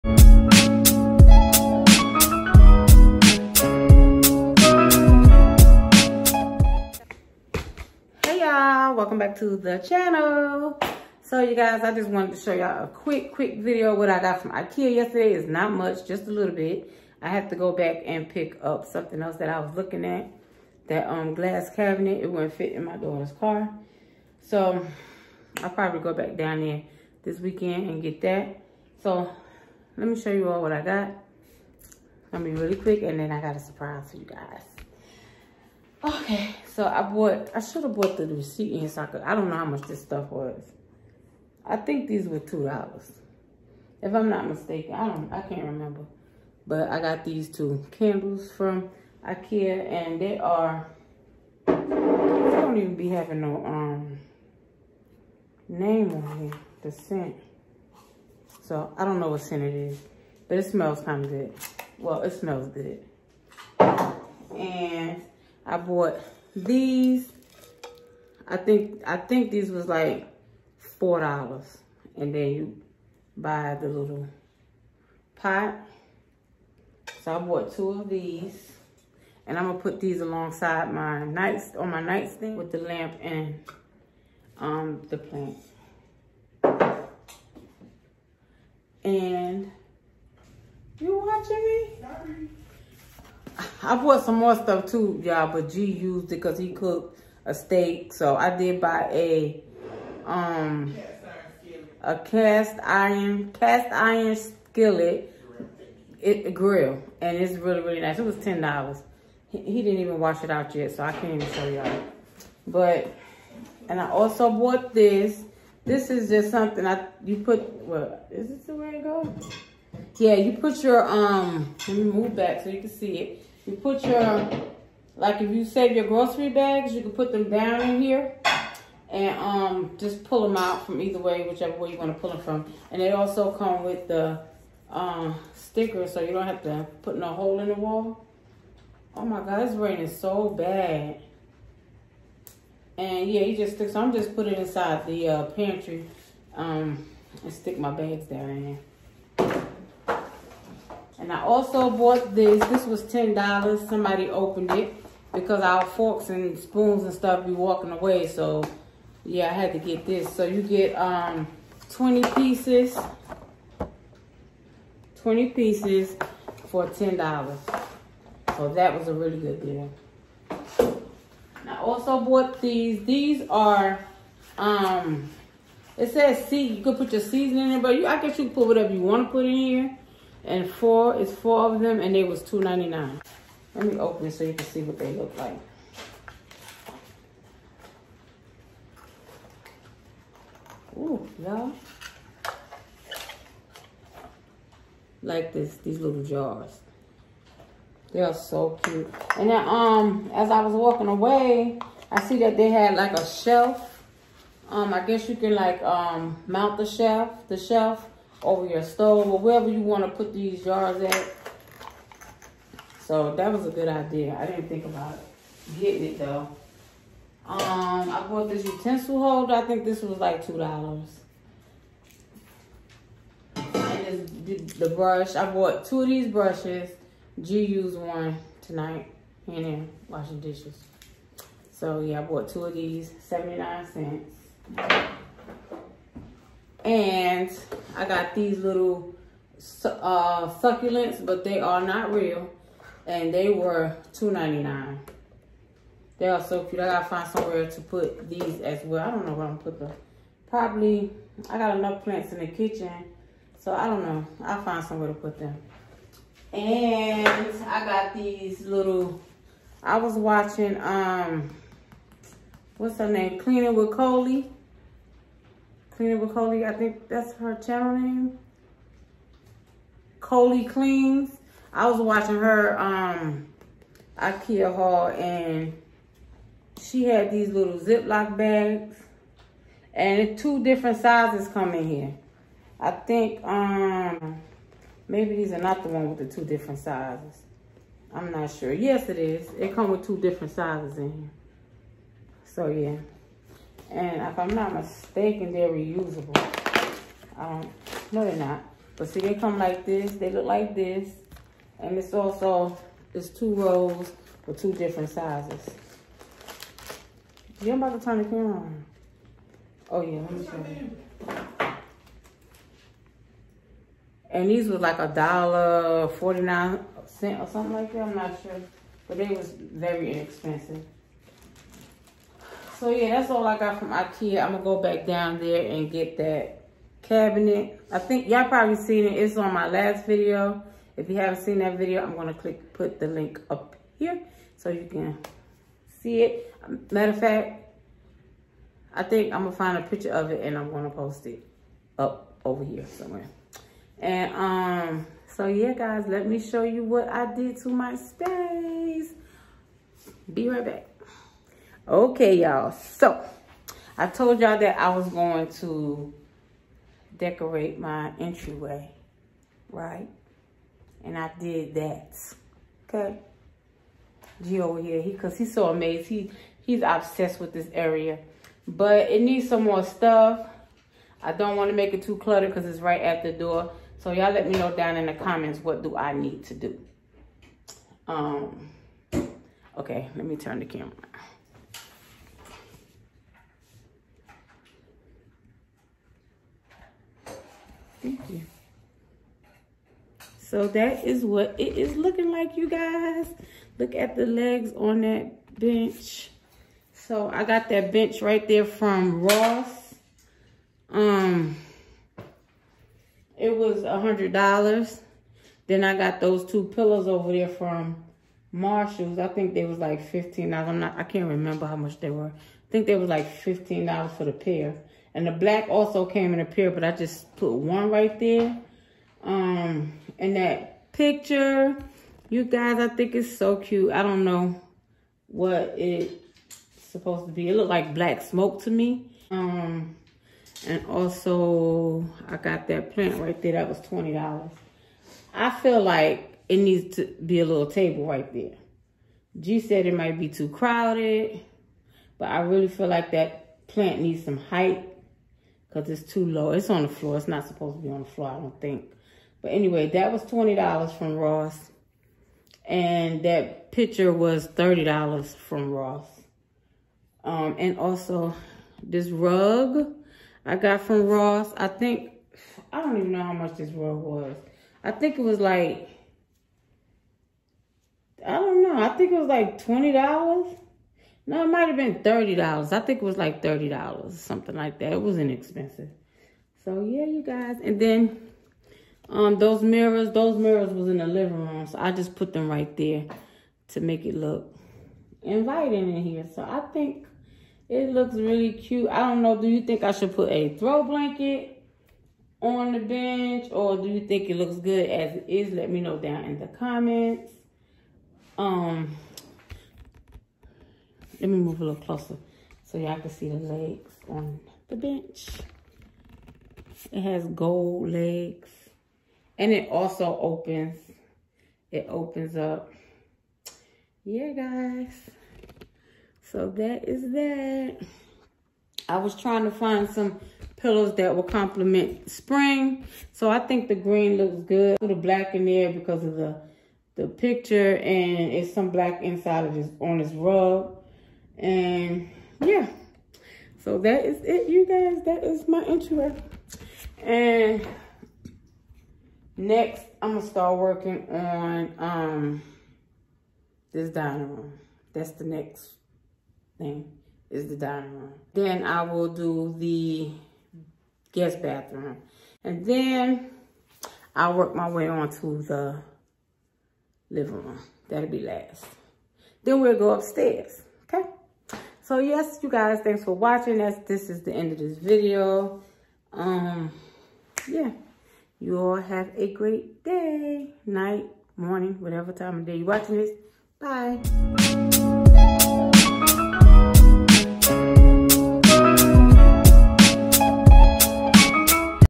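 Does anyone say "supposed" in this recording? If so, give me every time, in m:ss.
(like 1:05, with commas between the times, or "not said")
7:06, 7:27.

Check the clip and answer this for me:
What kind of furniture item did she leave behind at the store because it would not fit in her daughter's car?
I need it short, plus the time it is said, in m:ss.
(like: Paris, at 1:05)
glass cabinet, at 0:21.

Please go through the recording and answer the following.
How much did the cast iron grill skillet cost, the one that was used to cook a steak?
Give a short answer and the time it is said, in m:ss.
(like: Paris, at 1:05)
$10, at 1:48.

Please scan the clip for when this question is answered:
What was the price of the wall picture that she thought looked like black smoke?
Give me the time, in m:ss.
7:34.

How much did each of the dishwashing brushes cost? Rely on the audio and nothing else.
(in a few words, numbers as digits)
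79 cents.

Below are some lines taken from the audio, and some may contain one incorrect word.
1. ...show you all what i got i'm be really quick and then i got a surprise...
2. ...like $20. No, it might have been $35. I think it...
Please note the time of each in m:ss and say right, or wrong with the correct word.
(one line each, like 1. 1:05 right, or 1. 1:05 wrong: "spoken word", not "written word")
1. 0:30 right
2. 7:49 wrong: "30", not "35".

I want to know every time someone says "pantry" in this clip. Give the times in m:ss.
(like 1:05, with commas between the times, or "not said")
2:25.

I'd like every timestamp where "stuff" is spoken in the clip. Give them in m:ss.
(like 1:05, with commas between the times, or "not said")
0:40, 1:34, 2:37, 6:09.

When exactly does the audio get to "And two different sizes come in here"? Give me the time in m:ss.
4:39.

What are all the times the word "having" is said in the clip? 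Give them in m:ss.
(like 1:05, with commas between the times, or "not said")
0:53.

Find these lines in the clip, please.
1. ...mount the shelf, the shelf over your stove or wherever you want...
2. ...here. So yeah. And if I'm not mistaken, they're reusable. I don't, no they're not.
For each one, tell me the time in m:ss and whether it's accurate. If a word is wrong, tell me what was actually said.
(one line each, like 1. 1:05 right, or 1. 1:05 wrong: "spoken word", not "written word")
1. 3:26 right
2. 4:51 right.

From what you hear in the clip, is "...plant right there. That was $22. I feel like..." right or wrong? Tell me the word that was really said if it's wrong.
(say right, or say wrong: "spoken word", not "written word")
wrong: "20", not "22".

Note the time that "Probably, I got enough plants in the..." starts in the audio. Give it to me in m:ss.
4:10.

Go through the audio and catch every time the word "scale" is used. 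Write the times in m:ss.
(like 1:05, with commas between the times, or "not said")
not said.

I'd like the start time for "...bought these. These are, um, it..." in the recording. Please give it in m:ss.
2:52.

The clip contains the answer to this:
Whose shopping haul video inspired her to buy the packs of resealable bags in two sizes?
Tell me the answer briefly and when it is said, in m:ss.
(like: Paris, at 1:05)
Coley Cleans, at 4:30.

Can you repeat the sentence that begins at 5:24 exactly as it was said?
I'm gonna go back down there and get that cabinet.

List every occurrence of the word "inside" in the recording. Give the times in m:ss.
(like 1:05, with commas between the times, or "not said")
2:24, 8:49.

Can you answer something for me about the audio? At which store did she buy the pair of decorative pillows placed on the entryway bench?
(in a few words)
Marshalls.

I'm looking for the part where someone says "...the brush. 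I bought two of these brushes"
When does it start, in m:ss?
3:44.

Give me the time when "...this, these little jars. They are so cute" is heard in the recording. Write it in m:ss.
3:15.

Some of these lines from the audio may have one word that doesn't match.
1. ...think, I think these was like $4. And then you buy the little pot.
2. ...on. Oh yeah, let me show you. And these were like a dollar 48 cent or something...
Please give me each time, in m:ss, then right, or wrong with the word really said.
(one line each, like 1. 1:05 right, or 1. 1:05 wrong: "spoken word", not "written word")
1. 1:08 right
2. 5:08 wrong: "49", not "48".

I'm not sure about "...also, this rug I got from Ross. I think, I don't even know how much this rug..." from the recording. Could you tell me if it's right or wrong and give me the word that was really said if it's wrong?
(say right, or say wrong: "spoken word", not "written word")
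right.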